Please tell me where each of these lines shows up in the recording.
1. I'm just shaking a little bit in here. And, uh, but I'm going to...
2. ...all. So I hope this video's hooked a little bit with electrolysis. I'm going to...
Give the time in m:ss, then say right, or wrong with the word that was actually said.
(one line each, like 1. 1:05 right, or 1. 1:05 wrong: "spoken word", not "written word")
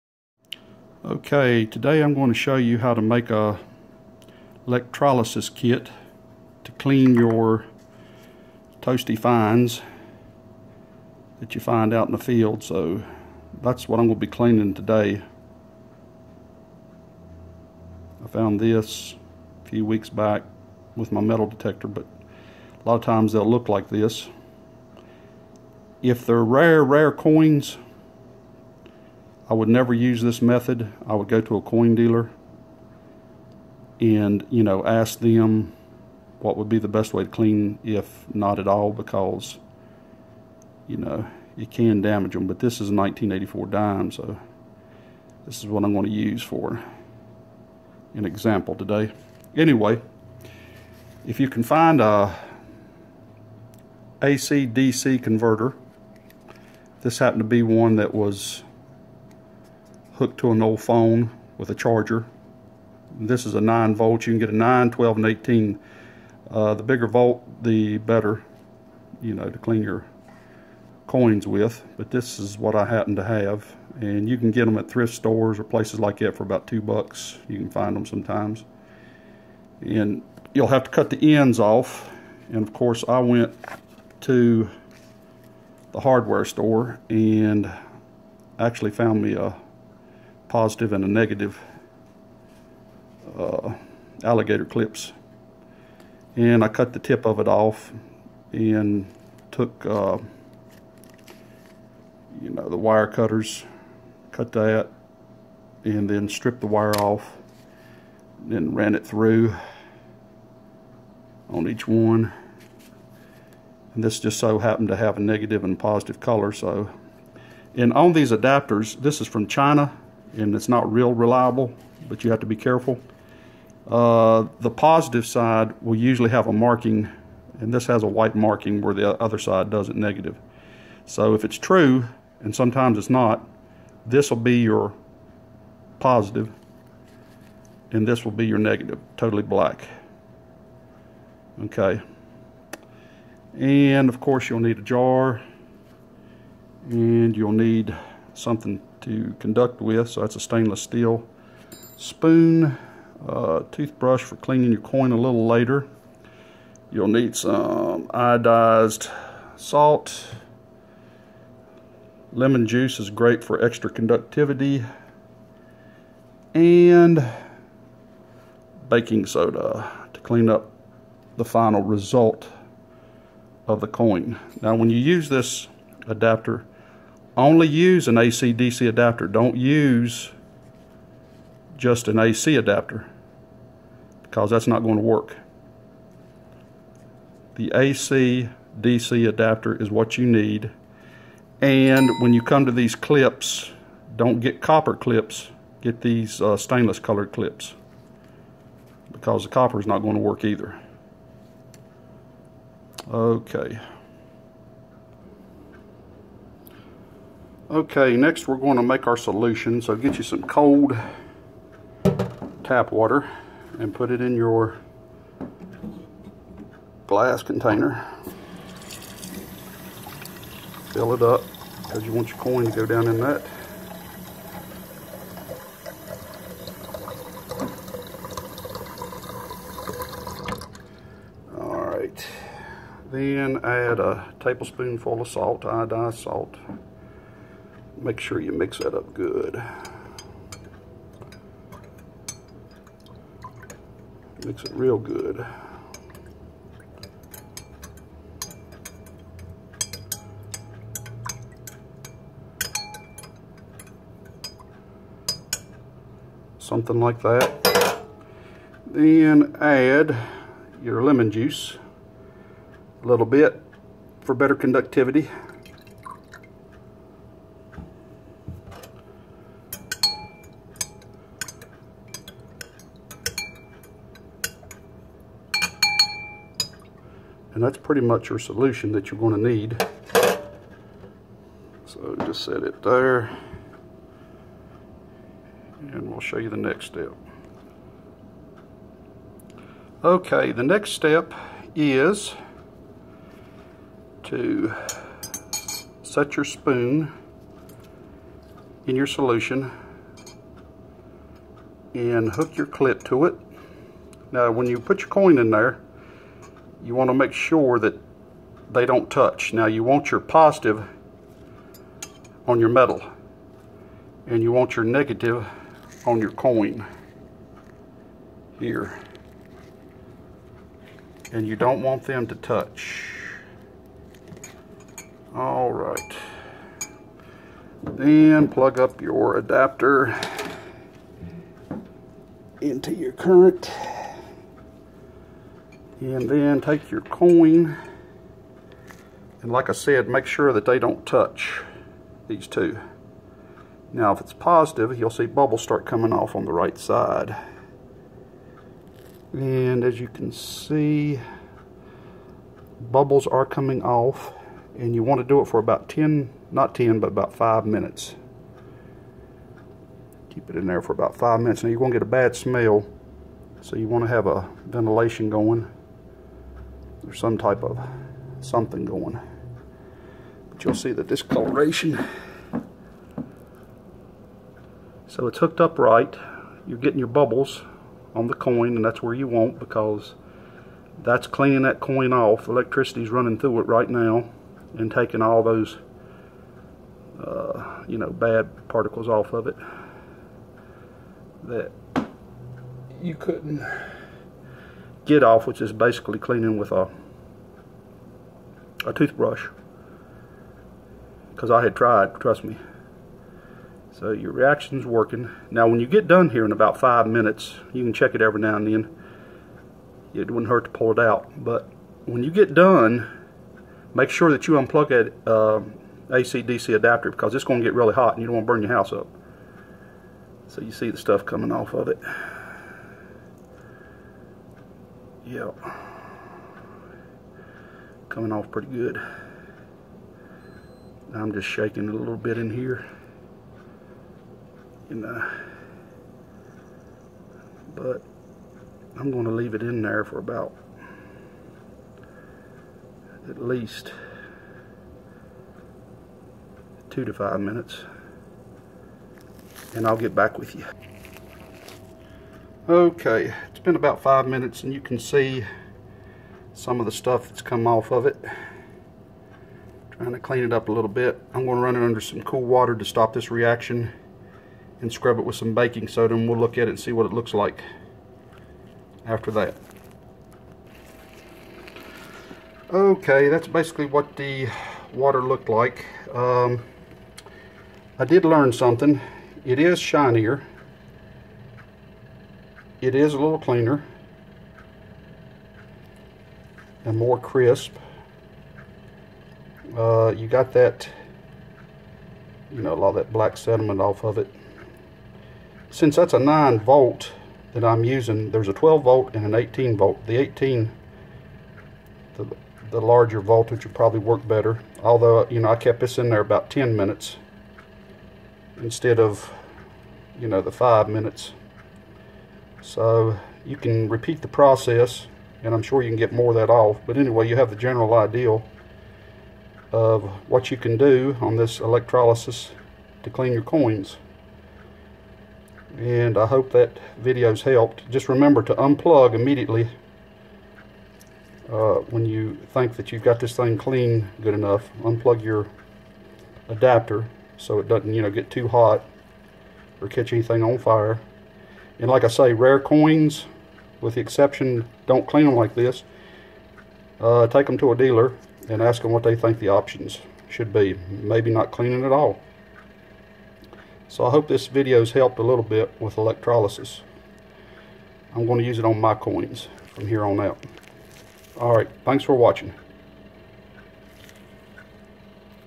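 1. 7:11 right
2. 9:11 wrong: "helped", not "hooked".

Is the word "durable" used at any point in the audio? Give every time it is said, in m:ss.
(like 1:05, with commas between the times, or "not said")
not said.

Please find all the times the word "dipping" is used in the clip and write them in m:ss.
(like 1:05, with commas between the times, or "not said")
not said.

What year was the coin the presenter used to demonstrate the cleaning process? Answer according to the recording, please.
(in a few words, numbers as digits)
1984.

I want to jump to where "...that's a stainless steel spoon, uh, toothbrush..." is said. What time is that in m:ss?
2:30.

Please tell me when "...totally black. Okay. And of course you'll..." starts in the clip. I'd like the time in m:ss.
2:19.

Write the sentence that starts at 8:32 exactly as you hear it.
So you can repeat the process, and I'm sure you can get more of that off.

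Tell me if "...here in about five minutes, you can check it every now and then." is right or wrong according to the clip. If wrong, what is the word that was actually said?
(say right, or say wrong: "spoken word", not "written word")
right.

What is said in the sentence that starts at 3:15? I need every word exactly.
Get these uh, stainless colored clips because the copper is not going to work either.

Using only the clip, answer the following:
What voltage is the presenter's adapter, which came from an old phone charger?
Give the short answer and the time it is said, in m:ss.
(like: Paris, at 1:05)
9 volt, at 1:03.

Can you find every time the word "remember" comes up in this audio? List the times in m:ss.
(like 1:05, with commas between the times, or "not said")
8:48.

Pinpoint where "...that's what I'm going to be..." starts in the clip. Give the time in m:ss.
0:13.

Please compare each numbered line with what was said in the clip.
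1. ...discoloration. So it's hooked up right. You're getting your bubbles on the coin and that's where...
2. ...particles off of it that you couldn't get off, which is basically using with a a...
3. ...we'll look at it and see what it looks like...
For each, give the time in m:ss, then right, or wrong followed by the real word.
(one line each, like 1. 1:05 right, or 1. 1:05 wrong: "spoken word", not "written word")
1. 6:11 right
2. 6:28 wrong: "cleaning", not "using"
3. 7:46 right.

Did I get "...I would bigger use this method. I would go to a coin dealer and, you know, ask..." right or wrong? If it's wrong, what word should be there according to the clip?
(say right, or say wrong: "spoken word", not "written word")
wrong: "never", not "bigger".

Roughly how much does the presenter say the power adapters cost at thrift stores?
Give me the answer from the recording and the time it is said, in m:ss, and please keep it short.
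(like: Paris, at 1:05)
about two bucks, at 1:16.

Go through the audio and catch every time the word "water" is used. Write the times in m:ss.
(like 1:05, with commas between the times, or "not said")
3:32, 7:42, 7:54.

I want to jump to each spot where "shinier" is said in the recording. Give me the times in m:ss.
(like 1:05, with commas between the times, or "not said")
7:59.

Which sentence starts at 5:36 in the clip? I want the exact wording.
And then take your coin, and like I said, make sure that they don't touch these two.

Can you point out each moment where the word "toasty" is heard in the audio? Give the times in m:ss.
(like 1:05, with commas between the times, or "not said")
0:08.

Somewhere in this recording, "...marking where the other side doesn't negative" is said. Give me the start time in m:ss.
2:08.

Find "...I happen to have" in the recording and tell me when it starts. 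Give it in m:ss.
1:12.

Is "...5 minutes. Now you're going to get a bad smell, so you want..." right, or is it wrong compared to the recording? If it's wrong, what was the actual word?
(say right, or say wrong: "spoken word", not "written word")
right.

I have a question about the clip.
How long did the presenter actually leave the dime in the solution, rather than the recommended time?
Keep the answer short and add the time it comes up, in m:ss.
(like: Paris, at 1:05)
about 10 minutes, at 8:26.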